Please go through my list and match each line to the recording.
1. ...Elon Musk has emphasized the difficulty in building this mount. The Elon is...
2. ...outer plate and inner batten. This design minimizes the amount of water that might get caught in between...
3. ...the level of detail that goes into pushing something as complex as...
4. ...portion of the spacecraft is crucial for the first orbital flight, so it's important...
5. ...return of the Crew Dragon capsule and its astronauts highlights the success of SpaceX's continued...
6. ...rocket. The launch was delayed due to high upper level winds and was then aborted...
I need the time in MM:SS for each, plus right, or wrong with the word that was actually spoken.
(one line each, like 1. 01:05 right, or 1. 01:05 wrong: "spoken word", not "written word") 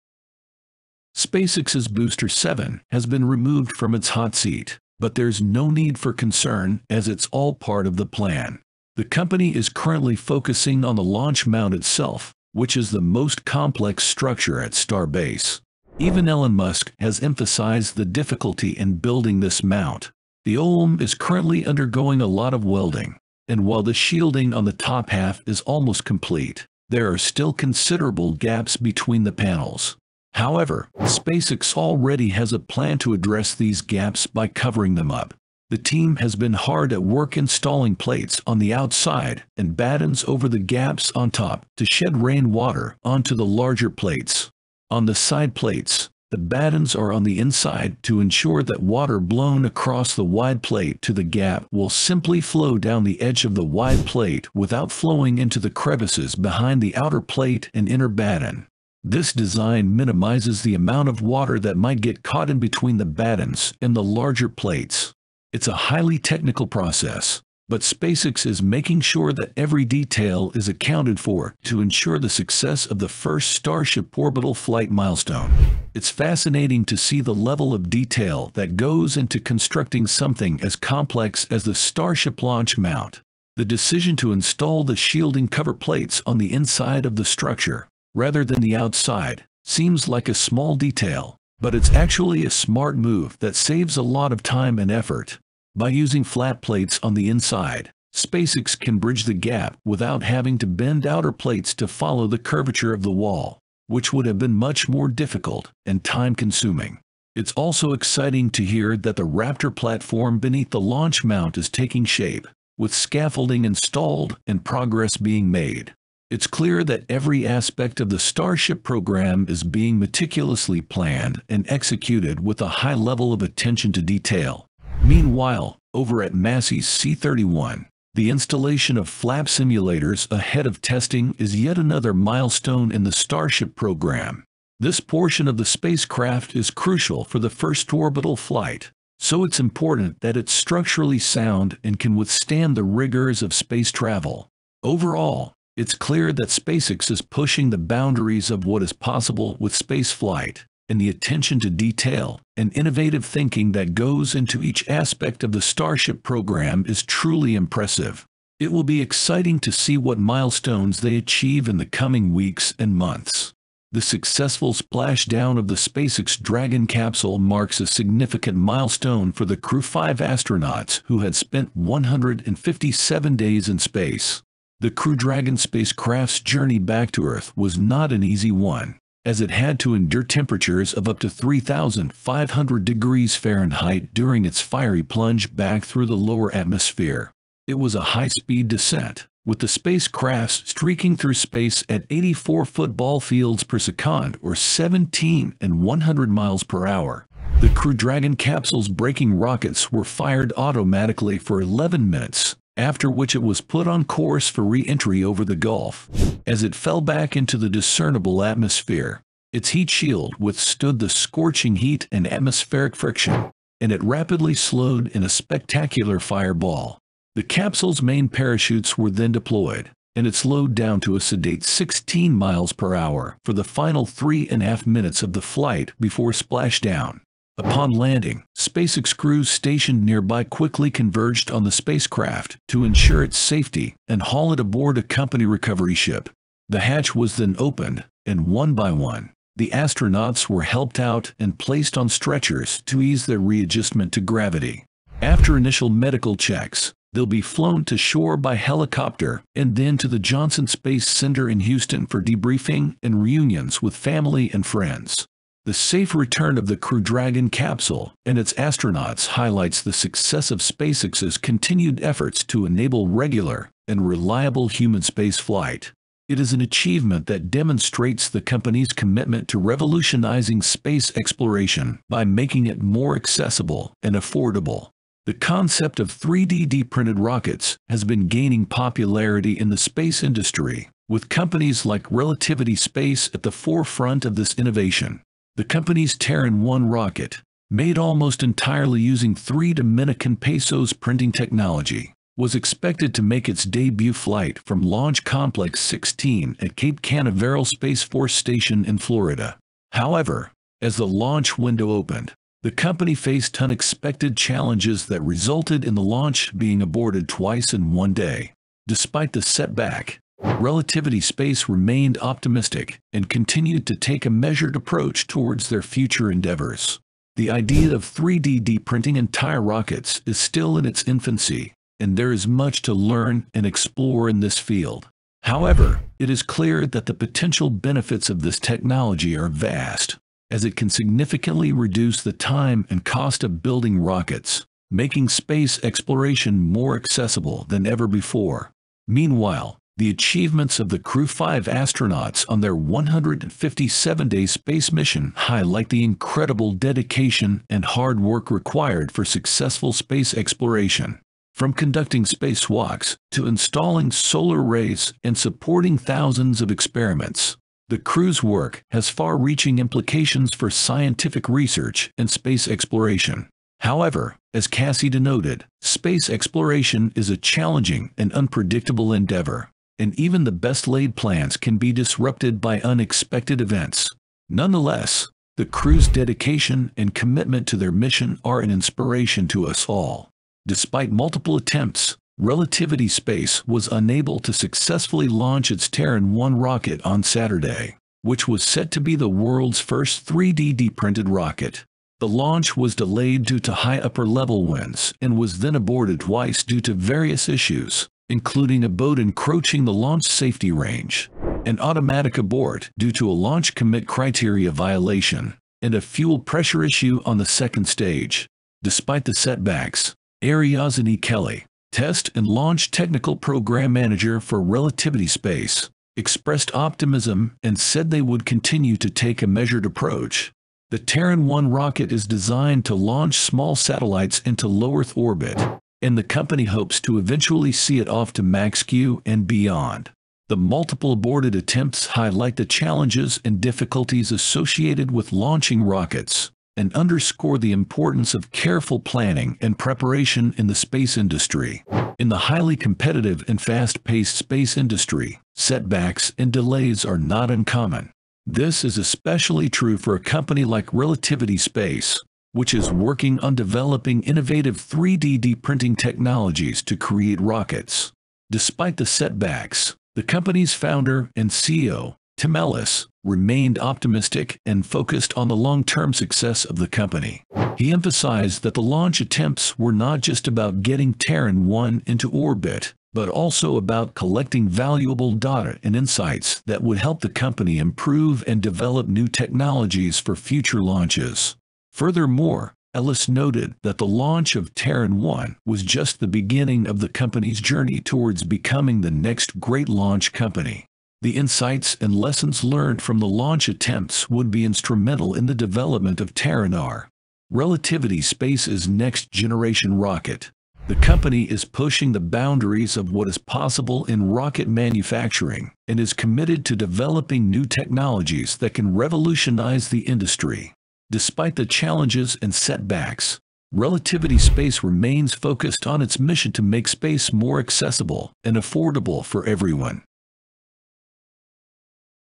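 1. 00:16 wrong: "OLM", not "Elon"
2. 00:56 right
3. 01:17 wrong: "constructing", not "pushing"
4. 02:15 right
5. 04:16 right
6. 06:31 right.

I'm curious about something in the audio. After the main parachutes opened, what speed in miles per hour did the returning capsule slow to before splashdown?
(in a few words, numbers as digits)
16 mph.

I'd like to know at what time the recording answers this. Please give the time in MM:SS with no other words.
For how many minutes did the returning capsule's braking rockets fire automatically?
03:21.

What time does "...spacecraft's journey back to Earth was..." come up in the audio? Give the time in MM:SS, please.
02:55.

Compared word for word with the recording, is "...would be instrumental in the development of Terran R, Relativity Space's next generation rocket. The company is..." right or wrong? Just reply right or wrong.
right.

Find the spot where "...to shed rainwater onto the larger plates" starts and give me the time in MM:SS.
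00:41.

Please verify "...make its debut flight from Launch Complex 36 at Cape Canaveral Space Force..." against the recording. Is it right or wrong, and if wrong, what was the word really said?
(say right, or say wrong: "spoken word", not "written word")
wrong: "16", not "36".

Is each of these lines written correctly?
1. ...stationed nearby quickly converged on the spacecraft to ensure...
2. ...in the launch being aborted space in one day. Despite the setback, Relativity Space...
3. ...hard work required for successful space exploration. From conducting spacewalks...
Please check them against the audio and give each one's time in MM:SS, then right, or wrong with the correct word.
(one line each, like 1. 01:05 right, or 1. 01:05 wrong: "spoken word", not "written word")
1. 03:49 right
2. 05:05 wrong: "twice", not "space"
3. 05:47 right.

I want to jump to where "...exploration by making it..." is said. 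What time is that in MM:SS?
04:31.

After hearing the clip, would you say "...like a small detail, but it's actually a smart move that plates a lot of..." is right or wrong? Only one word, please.
wrong.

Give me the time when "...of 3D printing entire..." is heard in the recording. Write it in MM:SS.
05:17.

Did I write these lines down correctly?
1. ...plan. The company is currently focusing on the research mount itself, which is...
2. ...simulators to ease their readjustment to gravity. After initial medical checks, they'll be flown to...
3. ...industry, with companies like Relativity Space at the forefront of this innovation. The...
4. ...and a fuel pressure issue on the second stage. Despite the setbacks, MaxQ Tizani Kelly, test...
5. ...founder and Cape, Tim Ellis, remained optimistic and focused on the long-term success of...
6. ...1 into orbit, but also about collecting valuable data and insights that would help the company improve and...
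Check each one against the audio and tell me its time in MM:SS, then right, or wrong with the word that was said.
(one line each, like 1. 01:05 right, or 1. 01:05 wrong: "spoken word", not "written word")
1. 00:08 wrong: "launch", not "research"
2. 04:02 wrong: "stretchers", not "simulators"
3. 04:40 right
4. 06:45 wrong: "Arwa", not "MaxQ"
5. 07:40 wrong: "CEO", not "Cape"
6. 07:51 right.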